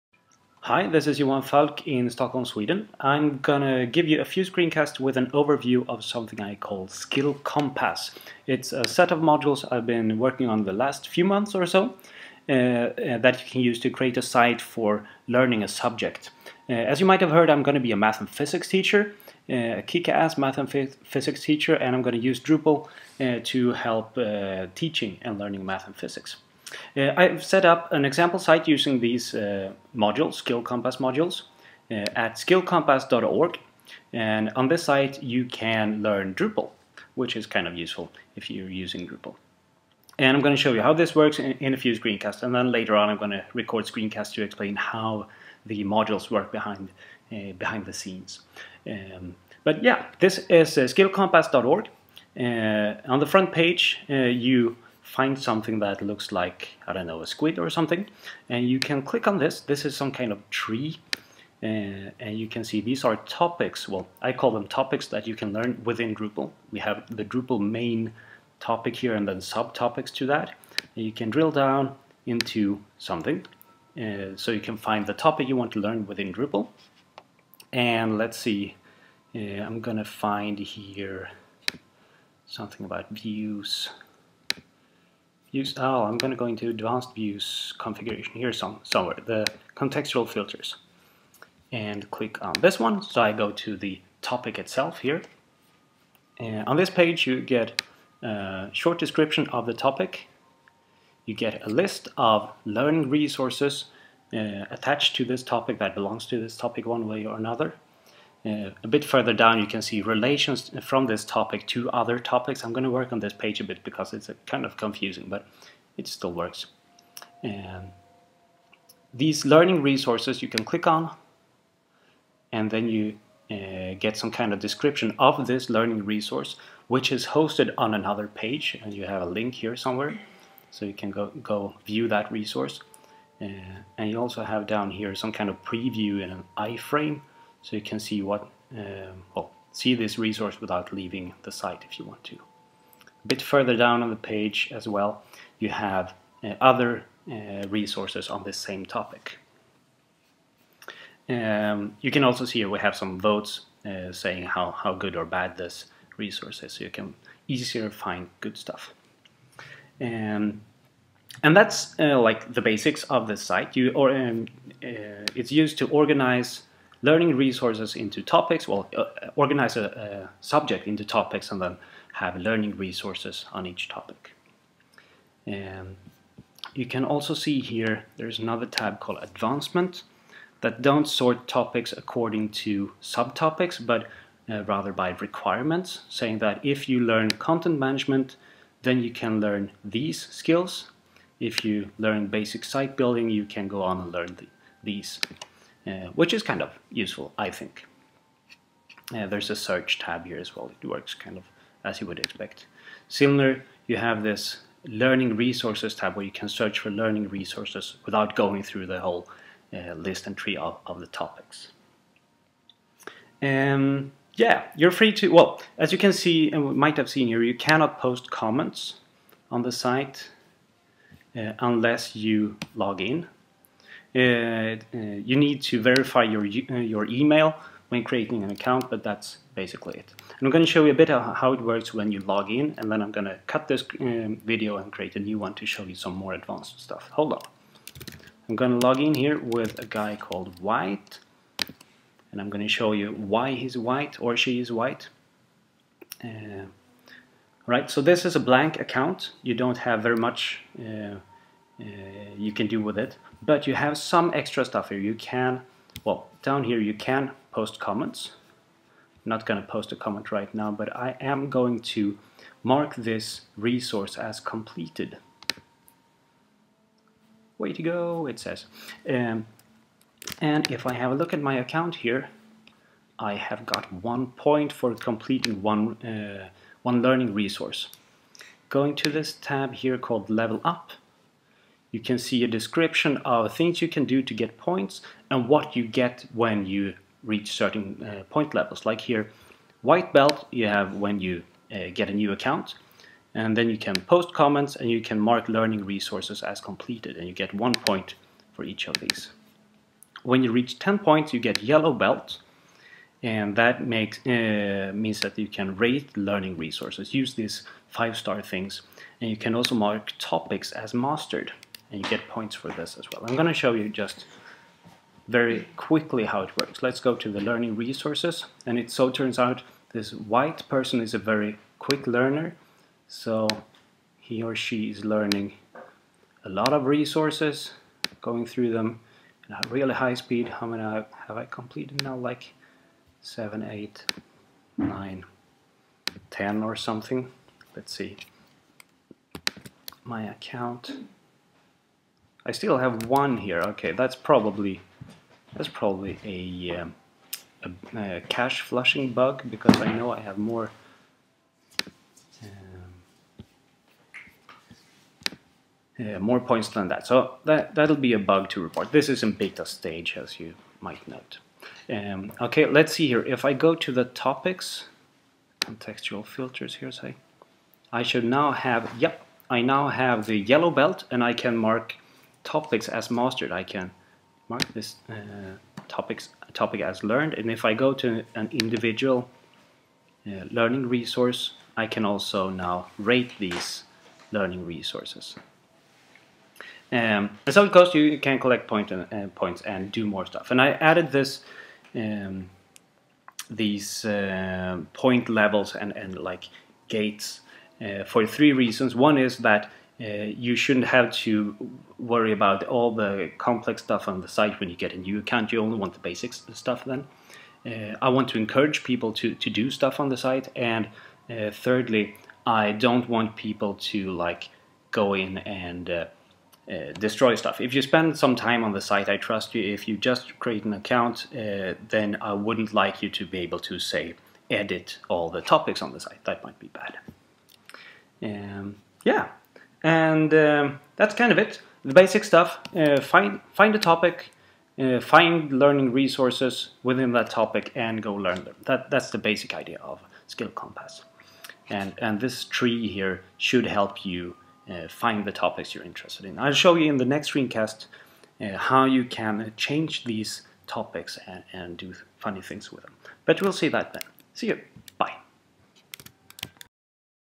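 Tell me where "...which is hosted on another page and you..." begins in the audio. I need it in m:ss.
2:06.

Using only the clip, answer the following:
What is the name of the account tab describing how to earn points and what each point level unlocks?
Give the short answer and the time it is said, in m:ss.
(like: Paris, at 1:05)
Level Up, at 4:40.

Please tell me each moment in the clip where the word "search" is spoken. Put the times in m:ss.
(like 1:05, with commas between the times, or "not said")
3:19, 3:26.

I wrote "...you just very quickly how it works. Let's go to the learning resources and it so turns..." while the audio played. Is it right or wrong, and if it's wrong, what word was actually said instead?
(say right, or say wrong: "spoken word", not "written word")
right.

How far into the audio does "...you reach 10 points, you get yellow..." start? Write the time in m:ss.
5:00.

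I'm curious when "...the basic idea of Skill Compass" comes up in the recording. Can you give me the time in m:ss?
7:19.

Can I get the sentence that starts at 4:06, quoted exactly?
Uh, right, so this is a blank account.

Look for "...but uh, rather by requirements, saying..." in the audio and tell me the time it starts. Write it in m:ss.
3:03.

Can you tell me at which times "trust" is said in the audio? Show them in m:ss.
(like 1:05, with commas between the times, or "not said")
6:59.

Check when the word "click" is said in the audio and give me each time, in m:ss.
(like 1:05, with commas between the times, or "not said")
0:59, 1:32, 2:00.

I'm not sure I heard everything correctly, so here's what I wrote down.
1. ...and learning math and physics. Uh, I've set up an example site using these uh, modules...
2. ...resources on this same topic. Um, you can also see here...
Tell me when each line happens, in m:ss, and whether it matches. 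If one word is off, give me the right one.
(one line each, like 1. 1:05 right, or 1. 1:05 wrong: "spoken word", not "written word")
1. 0:25 right
2. 2:27 right.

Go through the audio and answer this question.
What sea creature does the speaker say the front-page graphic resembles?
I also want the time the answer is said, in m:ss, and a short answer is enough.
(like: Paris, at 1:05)
A squid, at 0:57.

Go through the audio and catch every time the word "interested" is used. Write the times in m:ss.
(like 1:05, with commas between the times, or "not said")
7:25.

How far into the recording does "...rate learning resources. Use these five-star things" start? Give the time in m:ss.
5:05.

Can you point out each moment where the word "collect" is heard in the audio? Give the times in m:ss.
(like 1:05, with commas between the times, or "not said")
6:28.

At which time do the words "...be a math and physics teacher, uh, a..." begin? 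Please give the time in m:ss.
0:17.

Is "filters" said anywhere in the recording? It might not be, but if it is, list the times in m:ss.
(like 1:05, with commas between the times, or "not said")
1:30, 6:06.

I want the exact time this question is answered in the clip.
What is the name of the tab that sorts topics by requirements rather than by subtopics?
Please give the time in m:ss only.
2:59.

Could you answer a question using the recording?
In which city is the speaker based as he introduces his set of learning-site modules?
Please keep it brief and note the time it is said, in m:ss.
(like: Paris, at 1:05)
Stockholm, at 0:02.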